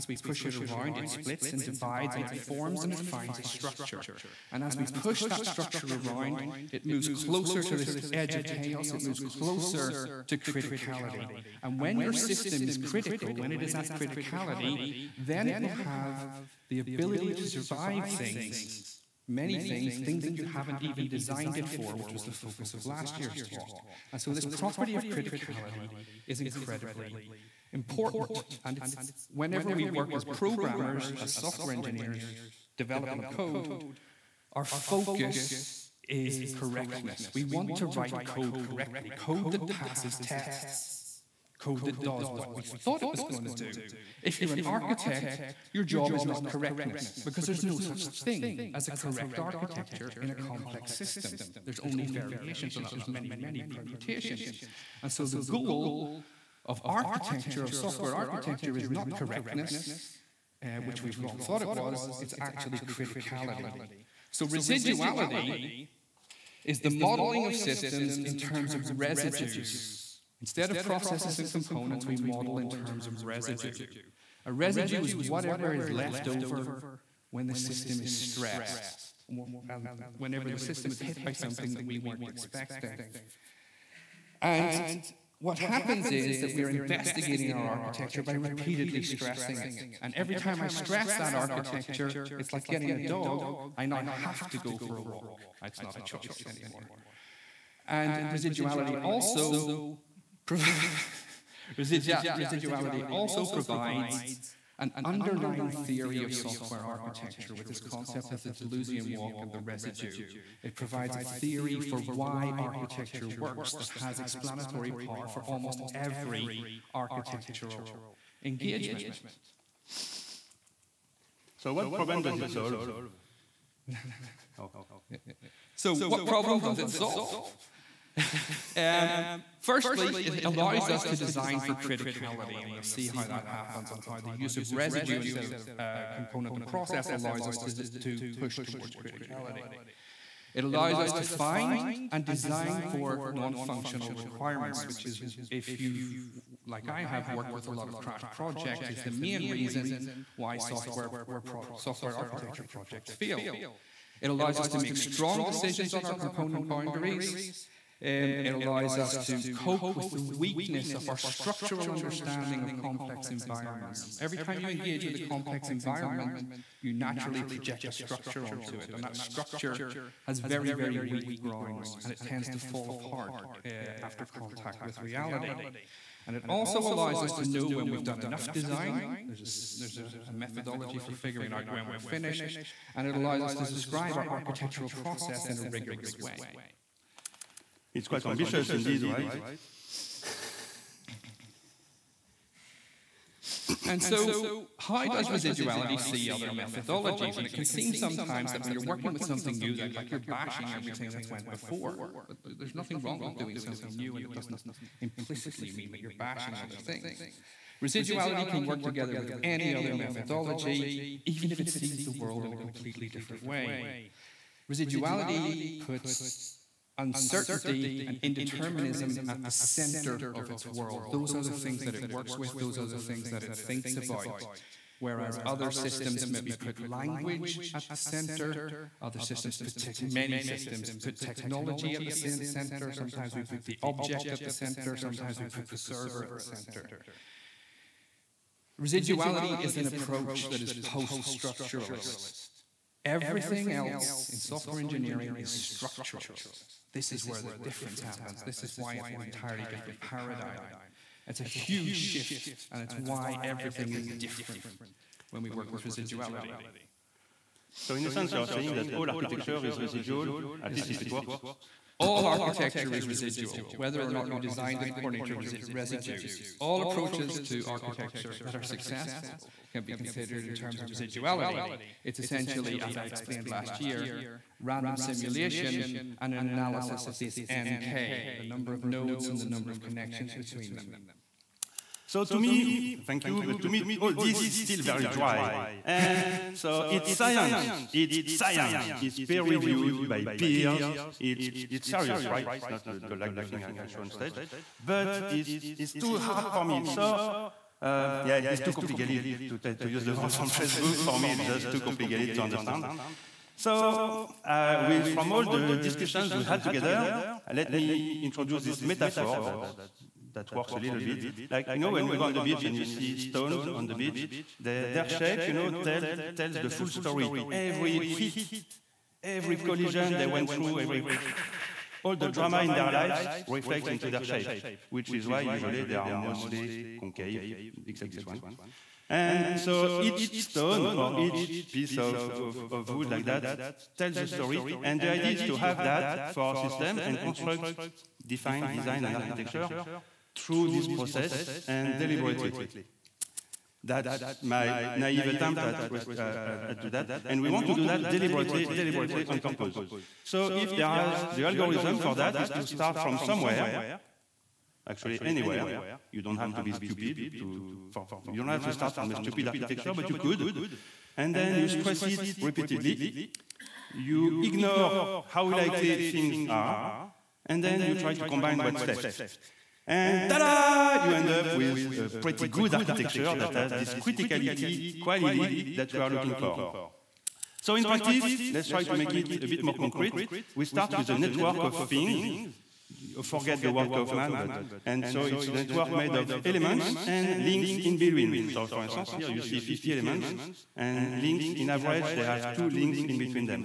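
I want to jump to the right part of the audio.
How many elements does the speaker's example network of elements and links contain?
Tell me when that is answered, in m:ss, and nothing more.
6:29.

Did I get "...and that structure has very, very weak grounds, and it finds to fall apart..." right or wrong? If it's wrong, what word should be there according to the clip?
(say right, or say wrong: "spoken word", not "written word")
wrong: "tends", not "finds".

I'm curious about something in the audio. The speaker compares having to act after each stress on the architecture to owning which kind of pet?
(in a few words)
A dog.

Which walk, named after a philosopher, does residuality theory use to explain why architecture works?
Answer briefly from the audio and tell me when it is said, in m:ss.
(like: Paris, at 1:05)
Deleuzian walk, at 1:48.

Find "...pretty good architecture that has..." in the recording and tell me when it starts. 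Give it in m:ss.
6:12.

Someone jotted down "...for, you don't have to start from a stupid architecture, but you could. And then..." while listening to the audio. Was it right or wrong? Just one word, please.
right.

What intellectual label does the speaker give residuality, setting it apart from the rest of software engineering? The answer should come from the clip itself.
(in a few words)
Post structuralist.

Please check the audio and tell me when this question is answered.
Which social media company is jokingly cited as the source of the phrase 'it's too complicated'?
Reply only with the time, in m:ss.
5:00.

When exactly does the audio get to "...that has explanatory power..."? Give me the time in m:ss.
1:53.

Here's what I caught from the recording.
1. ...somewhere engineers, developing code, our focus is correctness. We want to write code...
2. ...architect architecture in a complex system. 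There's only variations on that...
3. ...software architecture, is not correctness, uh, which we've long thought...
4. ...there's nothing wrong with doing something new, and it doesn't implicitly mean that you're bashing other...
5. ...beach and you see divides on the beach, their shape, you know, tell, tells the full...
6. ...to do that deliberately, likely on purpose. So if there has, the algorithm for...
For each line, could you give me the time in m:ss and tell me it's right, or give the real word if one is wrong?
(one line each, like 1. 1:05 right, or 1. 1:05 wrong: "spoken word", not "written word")
1. 0:31 wrong: "software", not "somewhere"
2. 0:48 wrong: "correct", not "architect"
3. 0:57 right
4. 3:22 right
5. 5:12 wrong: "stones", not "divides"
6. 5:47 wrong: "deliberately", not "likely".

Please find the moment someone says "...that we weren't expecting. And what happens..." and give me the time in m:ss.
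1:21.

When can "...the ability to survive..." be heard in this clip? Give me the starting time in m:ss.
0:16.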